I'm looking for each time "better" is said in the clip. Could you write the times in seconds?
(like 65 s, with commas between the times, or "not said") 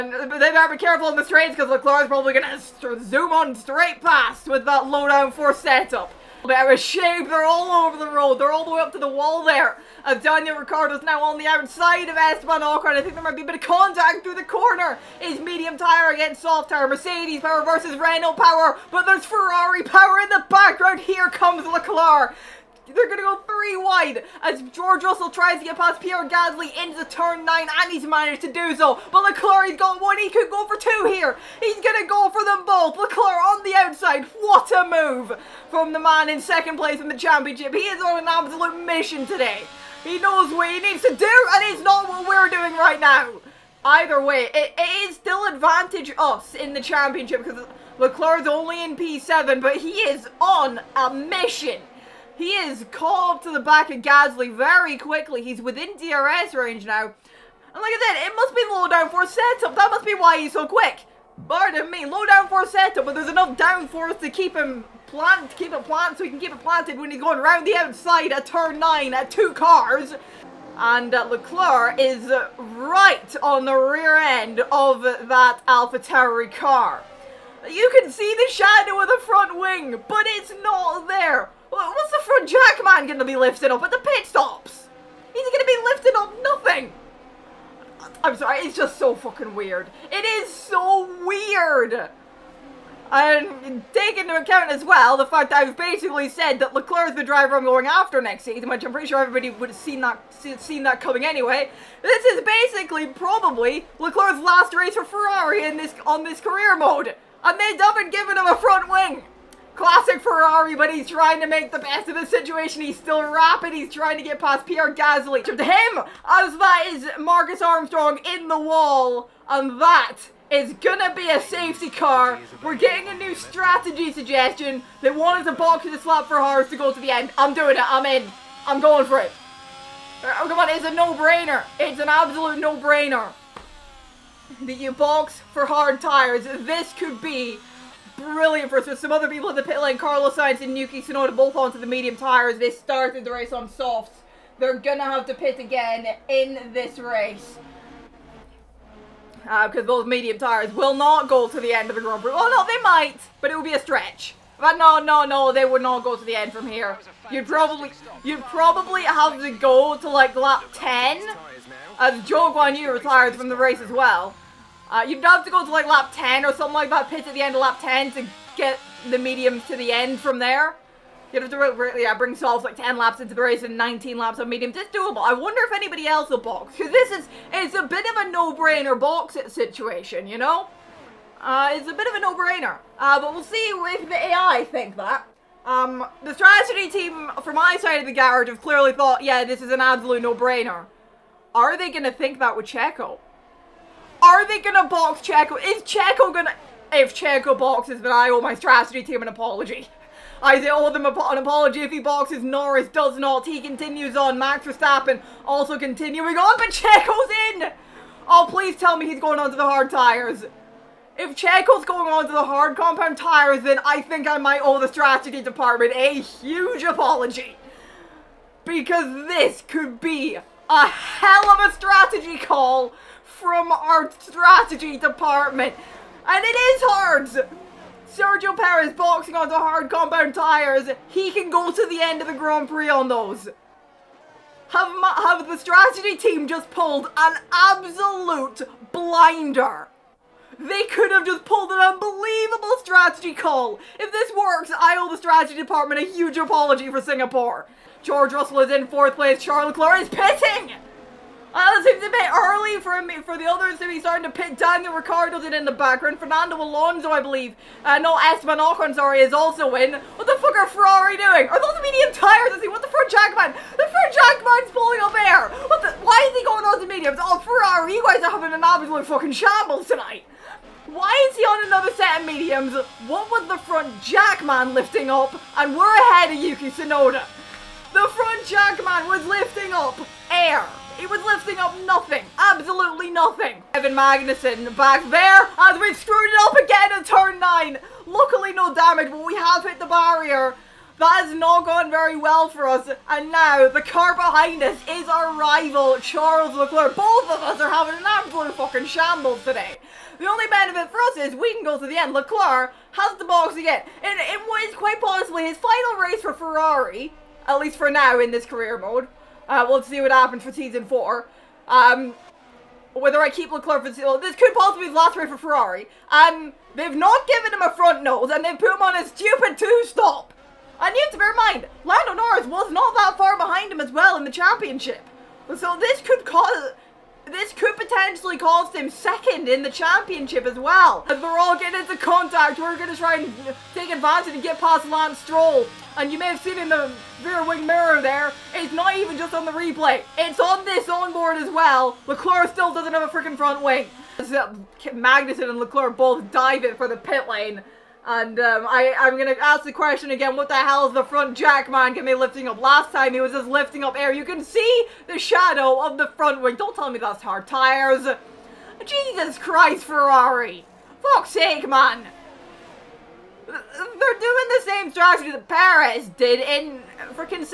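0 s, 6 s.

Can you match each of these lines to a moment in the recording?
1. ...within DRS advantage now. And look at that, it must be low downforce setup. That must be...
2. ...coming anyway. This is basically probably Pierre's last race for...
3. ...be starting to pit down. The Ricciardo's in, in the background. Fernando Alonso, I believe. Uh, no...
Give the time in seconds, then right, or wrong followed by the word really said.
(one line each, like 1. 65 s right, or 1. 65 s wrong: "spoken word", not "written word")
1. 55 s wrong: "range", not "advantage"
2. 101 s wrong: "Leclerc", not "Pierre"
3. 253 s right.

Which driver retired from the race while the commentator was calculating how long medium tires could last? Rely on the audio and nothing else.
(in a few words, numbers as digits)
Zhou Guanyu.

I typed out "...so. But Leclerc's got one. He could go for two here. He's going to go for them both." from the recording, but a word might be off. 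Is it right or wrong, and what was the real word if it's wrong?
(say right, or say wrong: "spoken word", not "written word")
right.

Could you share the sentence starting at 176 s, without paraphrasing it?
Because this is, it's a bit of a no-brainer box situation, you know?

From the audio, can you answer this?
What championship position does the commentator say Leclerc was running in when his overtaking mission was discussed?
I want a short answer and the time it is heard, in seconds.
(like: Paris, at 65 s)
P7, at 48 s.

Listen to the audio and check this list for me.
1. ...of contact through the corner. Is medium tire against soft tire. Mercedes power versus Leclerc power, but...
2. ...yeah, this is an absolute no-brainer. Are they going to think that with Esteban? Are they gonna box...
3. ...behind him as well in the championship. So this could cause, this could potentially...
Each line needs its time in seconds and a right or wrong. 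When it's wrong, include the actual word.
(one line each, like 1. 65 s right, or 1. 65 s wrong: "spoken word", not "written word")
1. 13 s wrong: "Renault", not "Leclerc"
2. 189 s wrong: "Checo", not "Esteban"
3. 323 s right.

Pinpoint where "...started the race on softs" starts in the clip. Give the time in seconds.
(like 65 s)
142 s.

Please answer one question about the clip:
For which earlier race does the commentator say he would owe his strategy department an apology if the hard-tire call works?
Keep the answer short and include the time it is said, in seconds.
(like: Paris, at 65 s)
Singapore, at 247 s.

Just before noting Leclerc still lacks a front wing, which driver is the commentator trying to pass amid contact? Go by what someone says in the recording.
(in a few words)
Lance Stroll.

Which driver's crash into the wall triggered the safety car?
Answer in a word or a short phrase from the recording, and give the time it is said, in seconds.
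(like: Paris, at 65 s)
Marcus Armstrong, at 117 s.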